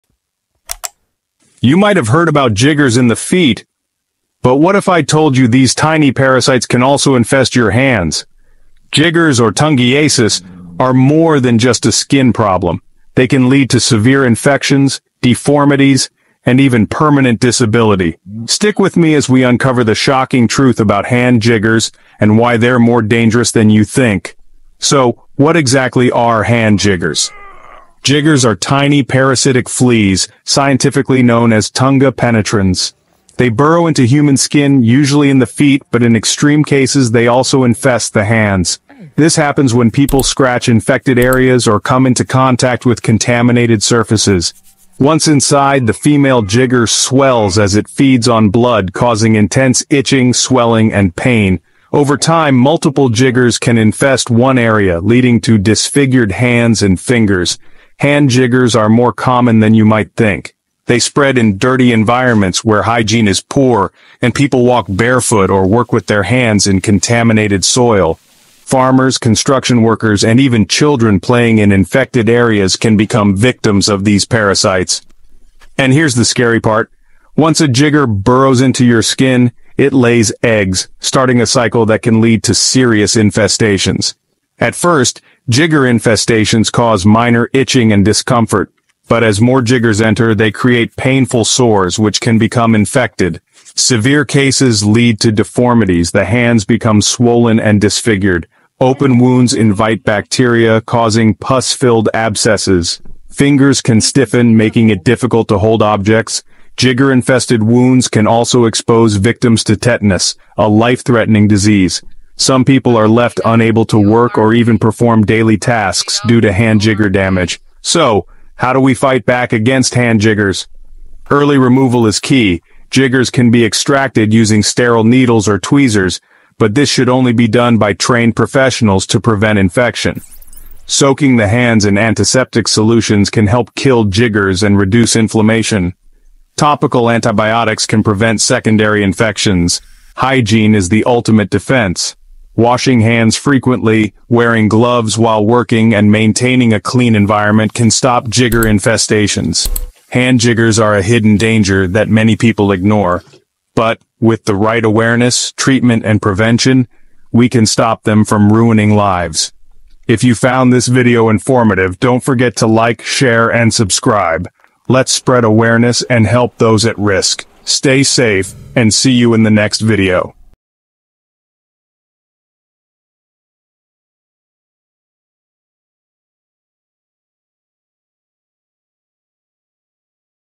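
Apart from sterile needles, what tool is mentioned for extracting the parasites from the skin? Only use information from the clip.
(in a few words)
Tweezers.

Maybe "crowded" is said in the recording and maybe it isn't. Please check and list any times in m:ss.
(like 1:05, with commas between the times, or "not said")
not said.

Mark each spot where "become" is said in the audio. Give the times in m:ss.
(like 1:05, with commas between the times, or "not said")
1:12, 1:32, 1:36.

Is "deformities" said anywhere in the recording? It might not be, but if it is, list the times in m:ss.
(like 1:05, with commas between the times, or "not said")
0:15, 1:35.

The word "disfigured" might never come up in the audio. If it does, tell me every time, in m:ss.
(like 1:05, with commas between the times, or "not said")
0:55, 1:37.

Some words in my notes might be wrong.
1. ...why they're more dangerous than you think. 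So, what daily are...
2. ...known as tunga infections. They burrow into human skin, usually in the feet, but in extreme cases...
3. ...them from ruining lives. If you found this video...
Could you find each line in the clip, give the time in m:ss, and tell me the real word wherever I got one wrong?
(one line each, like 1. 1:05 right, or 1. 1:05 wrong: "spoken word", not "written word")
1. 0:22 wrong: "exactly", not "daily"
2. 0:31 wrong: "penetrans", not "infections"
3. 2:38 right.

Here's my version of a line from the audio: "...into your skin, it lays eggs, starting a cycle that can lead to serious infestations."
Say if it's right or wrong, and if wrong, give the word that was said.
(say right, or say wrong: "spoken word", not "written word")
right.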